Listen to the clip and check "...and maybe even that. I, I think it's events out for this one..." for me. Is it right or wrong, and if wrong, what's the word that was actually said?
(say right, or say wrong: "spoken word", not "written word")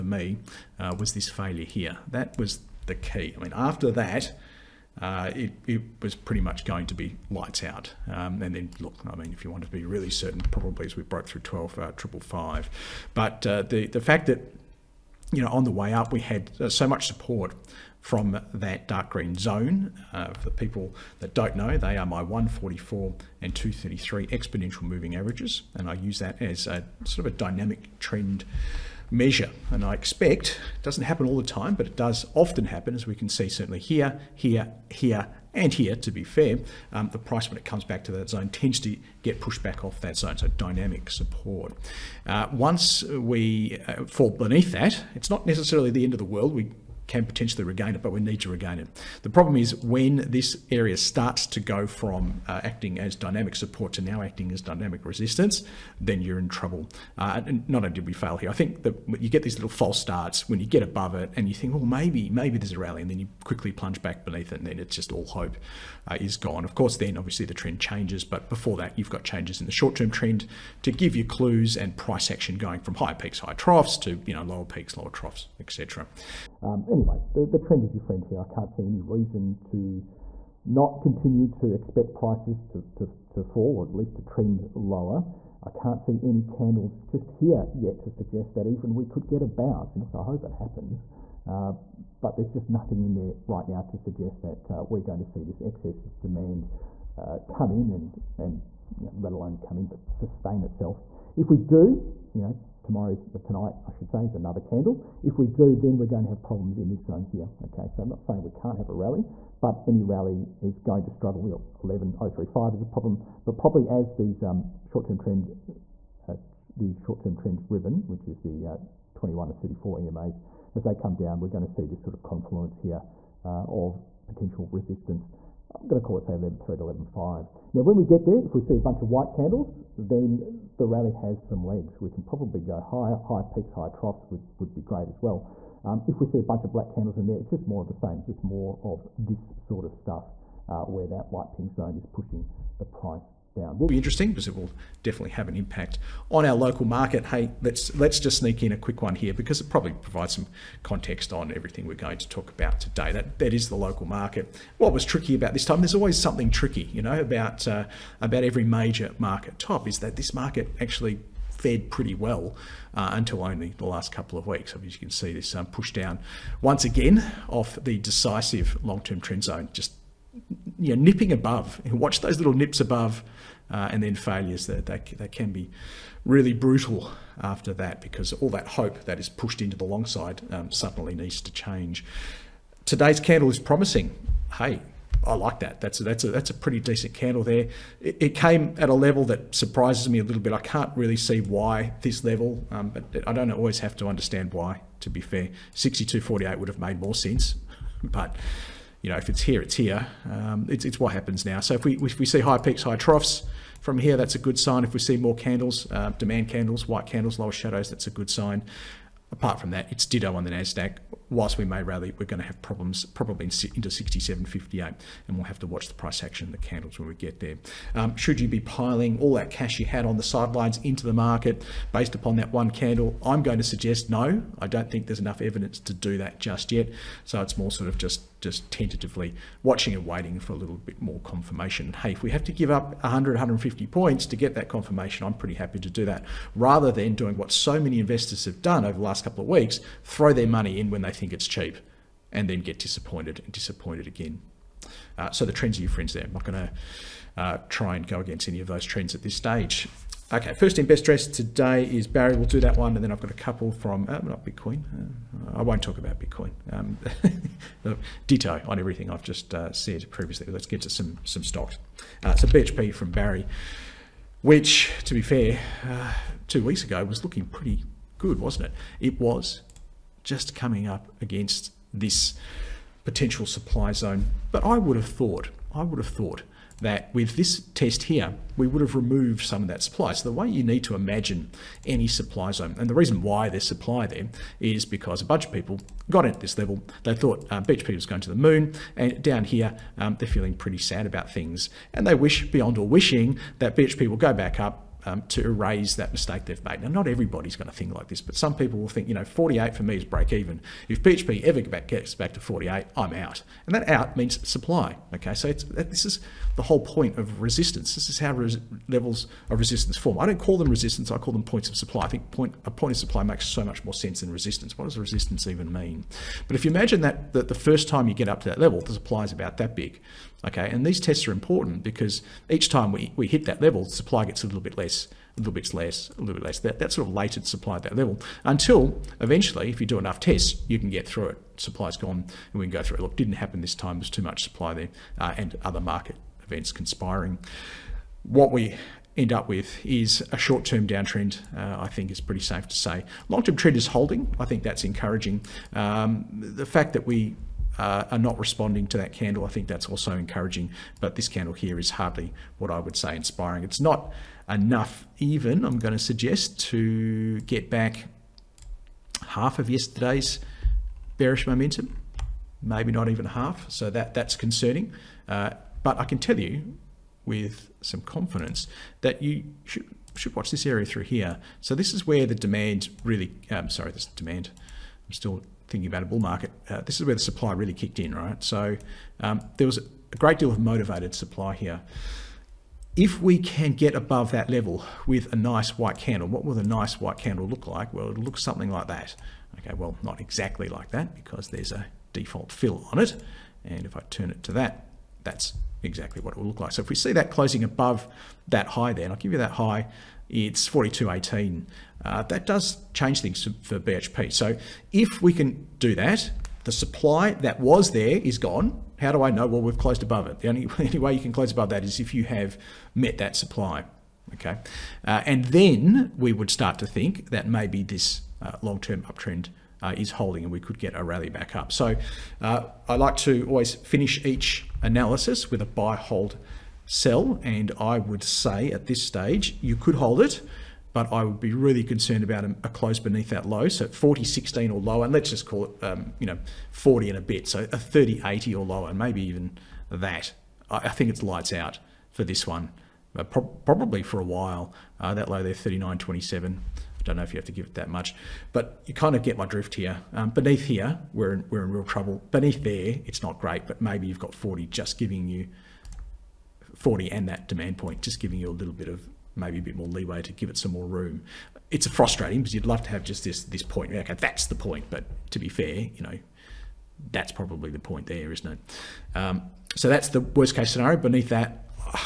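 wrong: "lights", not "events".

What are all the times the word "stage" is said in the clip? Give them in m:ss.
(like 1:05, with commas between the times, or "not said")
4:09, 7:09.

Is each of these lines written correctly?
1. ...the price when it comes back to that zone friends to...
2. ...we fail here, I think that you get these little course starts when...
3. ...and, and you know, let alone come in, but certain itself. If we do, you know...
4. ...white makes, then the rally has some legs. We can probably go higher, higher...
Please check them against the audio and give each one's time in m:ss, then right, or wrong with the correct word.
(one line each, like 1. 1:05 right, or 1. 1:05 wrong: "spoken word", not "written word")
1. 0:37 wrong: "tends", not "friends"
2. 0:58 wrong: "false", not "course"
3. 1:37 wrong: "sustain", not "certain"
4. 2:09 wrong: "candles", not "makes".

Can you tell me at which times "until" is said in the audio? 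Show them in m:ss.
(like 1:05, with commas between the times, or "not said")
2:43, 5:28.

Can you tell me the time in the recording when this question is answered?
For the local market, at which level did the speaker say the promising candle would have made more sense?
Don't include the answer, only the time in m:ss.
3:15.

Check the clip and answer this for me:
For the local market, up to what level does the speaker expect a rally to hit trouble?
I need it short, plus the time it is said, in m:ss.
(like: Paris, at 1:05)
67.58, at 3:33.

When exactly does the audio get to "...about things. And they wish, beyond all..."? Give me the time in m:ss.
4:51.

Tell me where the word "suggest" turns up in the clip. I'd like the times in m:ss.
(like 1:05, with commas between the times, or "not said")
1:28, 1:33, 3:43, 5:55.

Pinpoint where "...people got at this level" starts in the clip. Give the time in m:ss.
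4:45.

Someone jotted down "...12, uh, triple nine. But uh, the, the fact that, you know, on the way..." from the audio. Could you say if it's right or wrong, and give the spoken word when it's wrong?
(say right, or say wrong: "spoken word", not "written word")
wrong: "five", not "nine".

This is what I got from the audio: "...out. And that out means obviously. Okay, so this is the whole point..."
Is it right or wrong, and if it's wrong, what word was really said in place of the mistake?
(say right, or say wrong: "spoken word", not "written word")
wrong: "supply", not "obviously".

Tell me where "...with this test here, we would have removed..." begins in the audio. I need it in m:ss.
4:37.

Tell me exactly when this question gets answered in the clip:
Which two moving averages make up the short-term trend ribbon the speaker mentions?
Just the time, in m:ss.
1:59.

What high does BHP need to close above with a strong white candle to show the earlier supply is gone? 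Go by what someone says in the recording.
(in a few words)
42.18.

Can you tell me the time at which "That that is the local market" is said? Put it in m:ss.
2:33.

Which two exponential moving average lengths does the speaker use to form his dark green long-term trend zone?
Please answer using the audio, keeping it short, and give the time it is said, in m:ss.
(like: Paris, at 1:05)
144 and 233, at 0:22.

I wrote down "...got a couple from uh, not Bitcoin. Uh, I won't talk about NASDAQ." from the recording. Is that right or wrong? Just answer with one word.
wrong.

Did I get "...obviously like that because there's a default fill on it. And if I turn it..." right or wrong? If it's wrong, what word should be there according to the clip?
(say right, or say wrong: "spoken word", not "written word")
wrong: "exactly", not "obviously".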